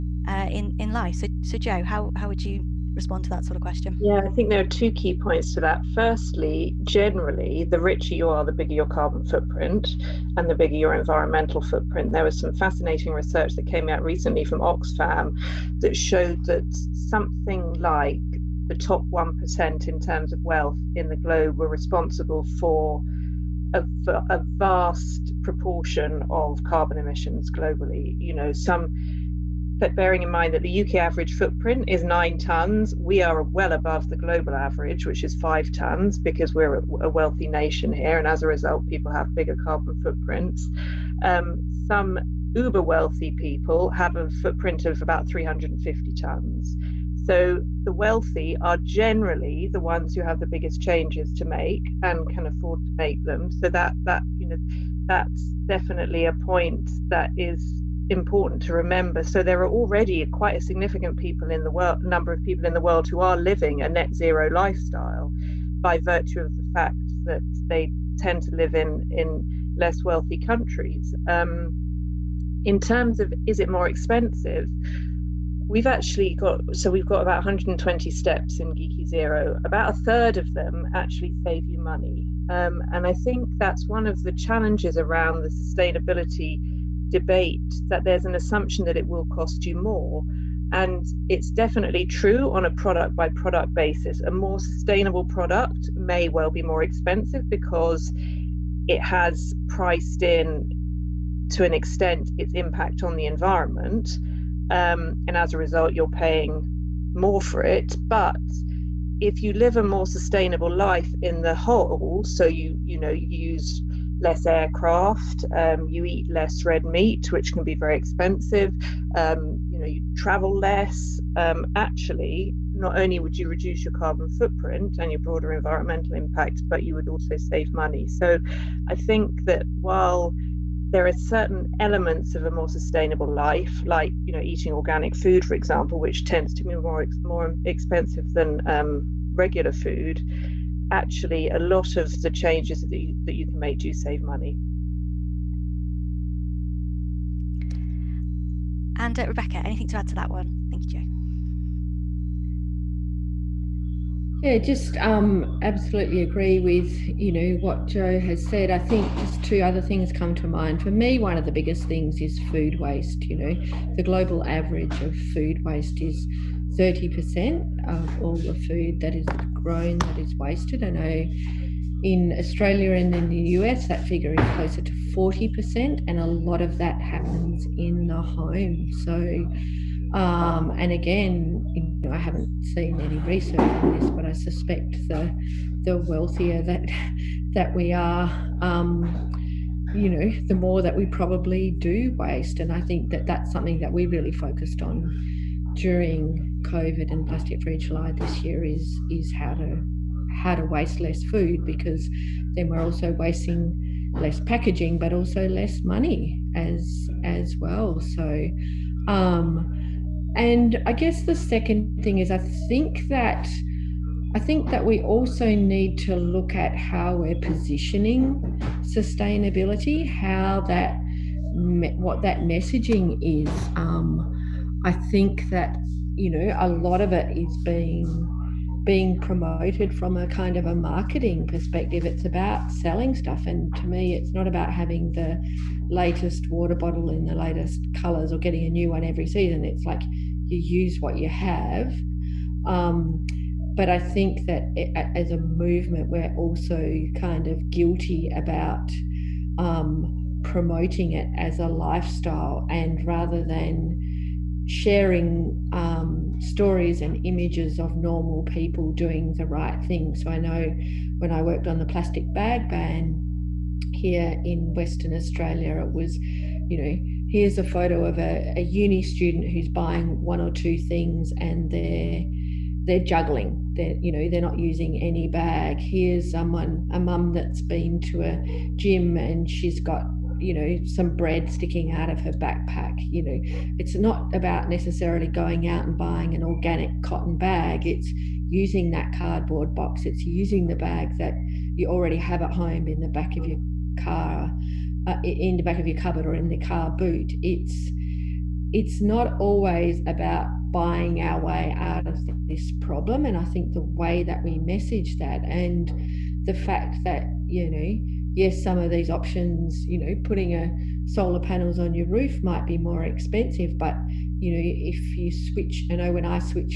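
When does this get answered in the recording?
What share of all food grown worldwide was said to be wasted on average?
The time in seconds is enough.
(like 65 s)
166 s.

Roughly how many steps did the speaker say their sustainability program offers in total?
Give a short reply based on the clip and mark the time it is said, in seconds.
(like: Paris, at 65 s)
120, at 77 s.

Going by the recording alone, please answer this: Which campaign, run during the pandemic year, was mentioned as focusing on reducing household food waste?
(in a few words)
Plastic Free July.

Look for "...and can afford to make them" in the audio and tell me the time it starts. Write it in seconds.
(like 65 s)
52 s.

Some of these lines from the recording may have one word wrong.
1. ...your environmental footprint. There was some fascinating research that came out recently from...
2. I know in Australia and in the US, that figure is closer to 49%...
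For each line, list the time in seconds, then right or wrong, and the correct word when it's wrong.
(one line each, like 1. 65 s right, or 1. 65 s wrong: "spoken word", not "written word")
1. 10 s right
2. 170 s wrong: "40", not "49".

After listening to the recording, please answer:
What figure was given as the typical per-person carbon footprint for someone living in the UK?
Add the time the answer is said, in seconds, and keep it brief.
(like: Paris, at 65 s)
9 tons, at 32 s.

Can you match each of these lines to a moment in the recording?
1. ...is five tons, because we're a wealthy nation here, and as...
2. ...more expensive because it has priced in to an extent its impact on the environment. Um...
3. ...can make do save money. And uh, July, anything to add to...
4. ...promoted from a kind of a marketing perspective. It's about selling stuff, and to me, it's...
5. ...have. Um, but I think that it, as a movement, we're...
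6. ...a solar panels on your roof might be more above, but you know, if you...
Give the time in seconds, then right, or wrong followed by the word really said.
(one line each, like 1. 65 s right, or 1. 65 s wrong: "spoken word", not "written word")
1. 35 s right
2. 96 s right
3. 143 s wrong: "Rebecca", not "July"
4. 229 s right
5. 241 s right
6. 310 s wrong: "expensive", not "above".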